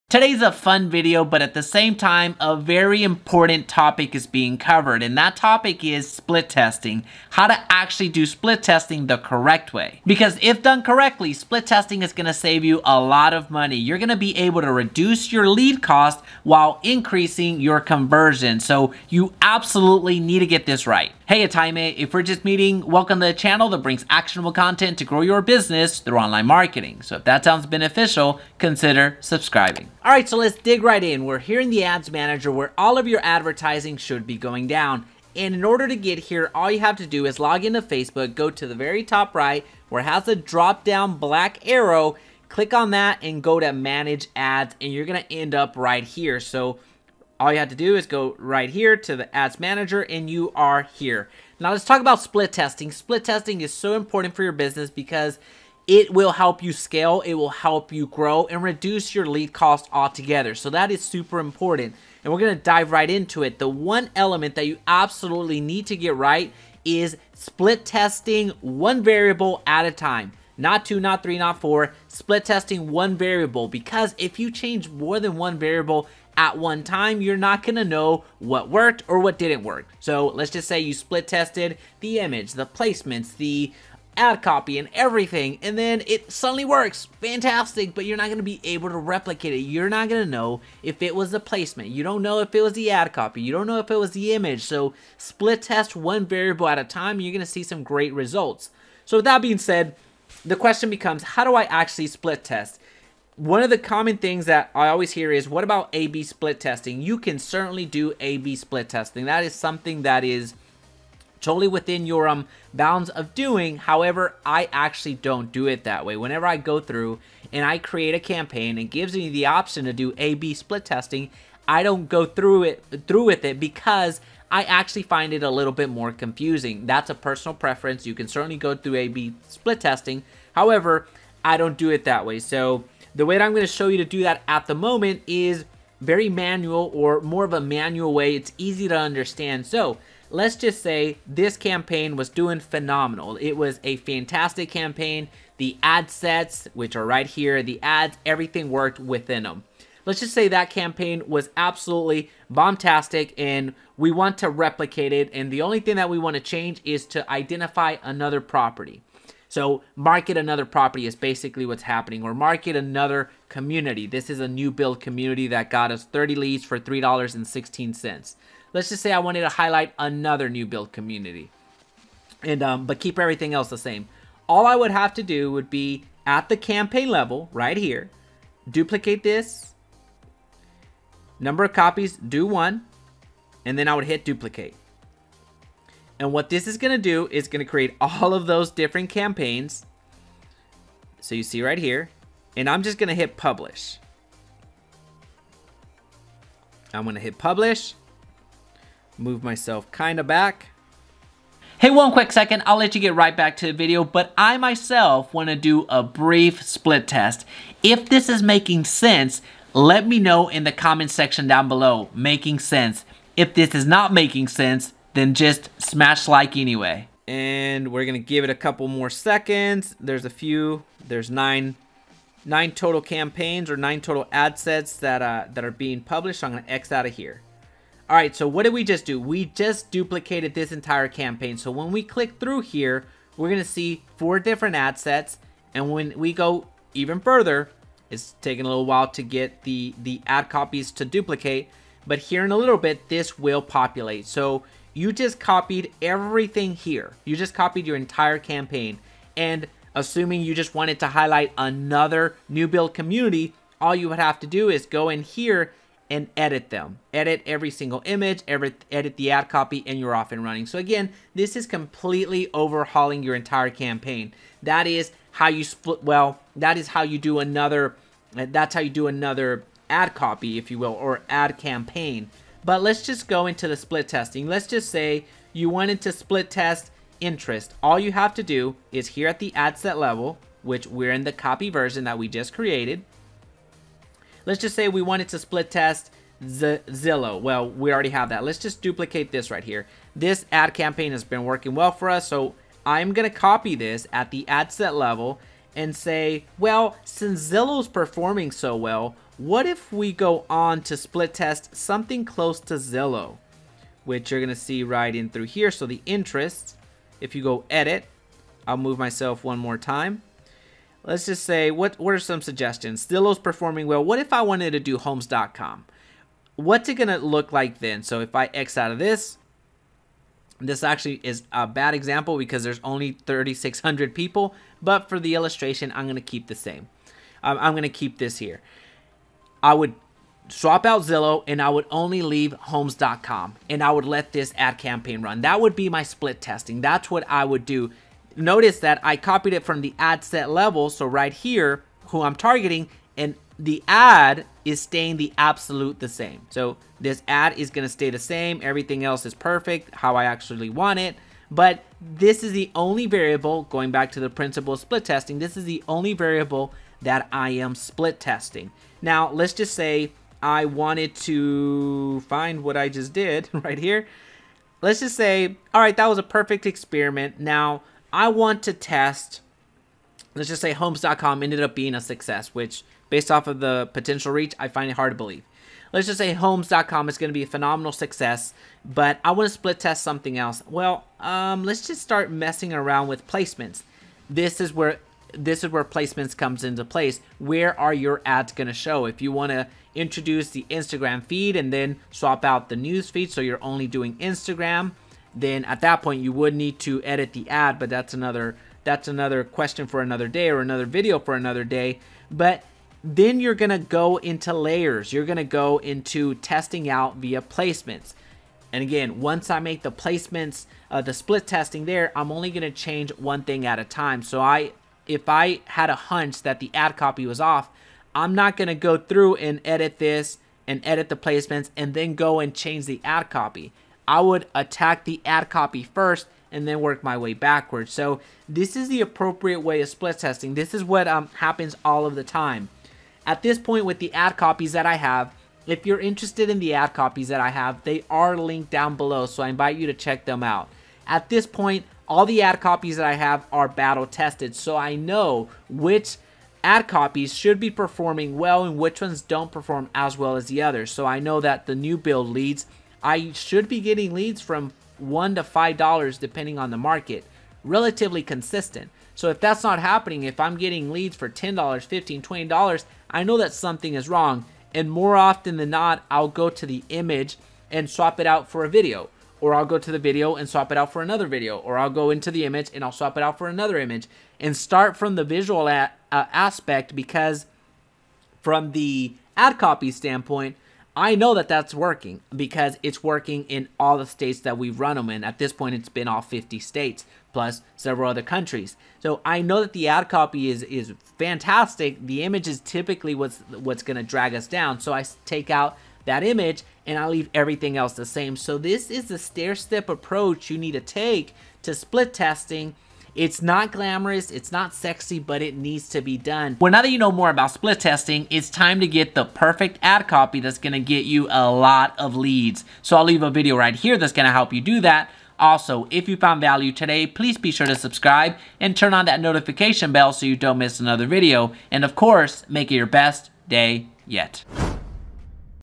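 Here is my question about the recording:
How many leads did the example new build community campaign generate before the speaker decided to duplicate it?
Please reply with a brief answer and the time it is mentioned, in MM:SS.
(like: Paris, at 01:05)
30, at 02:46.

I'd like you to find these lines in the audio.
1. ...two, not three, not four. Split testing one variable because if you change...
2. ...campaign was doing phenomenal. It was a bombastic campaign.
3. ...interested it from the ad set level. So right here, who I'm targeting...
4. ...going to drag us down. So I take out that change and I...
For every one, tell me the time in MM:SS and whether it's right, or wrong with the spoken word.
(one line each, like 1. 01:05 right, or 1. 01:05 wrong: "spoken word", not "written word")
1. 01:10 right
2. 02:21 wrong: "fantastic", not "bombastic"
3. 05:39 wrong: "copied", not "interested"
4. 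08:13 wrong: "image", not "change".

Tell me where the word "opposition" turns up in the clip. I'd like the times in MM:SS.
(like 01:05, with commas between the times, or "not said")
not said.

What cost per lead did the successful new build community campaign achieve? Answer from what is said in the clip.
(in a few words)
$3.16.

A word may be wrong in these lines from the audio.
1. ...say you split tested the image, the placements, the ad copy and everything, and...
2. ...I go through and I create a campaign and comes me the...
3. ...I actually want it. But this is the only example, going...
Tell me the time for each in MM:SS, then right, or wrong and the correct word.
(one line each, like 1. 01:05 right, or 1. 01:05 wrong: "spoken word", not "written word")
1. 01:20 right
2. 01:56 wrong: "gives", not "comes"
3. 05:50 wrong: "variable", not "example".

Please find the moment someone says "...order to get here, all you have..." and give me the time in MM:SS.
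00:35.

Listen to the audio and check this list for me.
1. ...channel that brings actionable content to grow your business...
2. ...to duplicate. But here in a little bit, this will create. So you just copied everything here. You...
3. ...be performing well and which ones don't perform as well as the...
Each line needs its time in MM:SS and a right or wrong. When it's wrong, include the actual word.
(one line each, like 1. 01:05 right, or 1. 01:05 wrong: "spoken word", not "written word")
1. 00:23 right
2. 04:00 wrong: "populate", not "create"
3. 07:27 right.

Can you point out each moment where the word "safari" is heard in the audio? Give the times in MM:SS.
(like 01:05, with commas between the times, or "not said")
not said.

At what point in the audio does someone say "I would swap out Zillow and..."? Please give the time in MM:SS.
05:29.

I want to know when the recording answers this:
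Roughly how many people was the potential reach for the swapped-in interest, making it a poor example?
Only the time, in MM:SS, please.
05:23.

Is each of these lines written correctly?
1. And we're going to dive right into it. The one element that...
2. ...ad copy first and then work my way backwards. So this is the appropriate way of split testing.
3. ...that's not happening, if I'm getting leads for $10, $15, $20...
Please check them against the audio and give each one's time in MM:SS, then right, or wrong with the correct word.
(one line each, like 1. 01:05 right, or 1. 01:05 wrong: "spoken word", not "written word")
1. 01:02 right
2. 07:05 right
3. 07:39 right.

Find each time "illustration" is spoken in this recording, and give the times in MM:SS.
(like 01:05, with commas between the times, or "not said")
05:25.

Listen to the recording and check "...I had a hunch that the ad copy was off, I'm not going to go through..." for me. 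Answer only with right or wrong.
right.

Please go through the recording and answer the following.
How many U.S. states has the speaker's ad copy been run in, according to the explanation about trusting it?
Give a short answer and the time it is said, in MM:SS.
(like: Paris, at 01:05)
50, at 08:06.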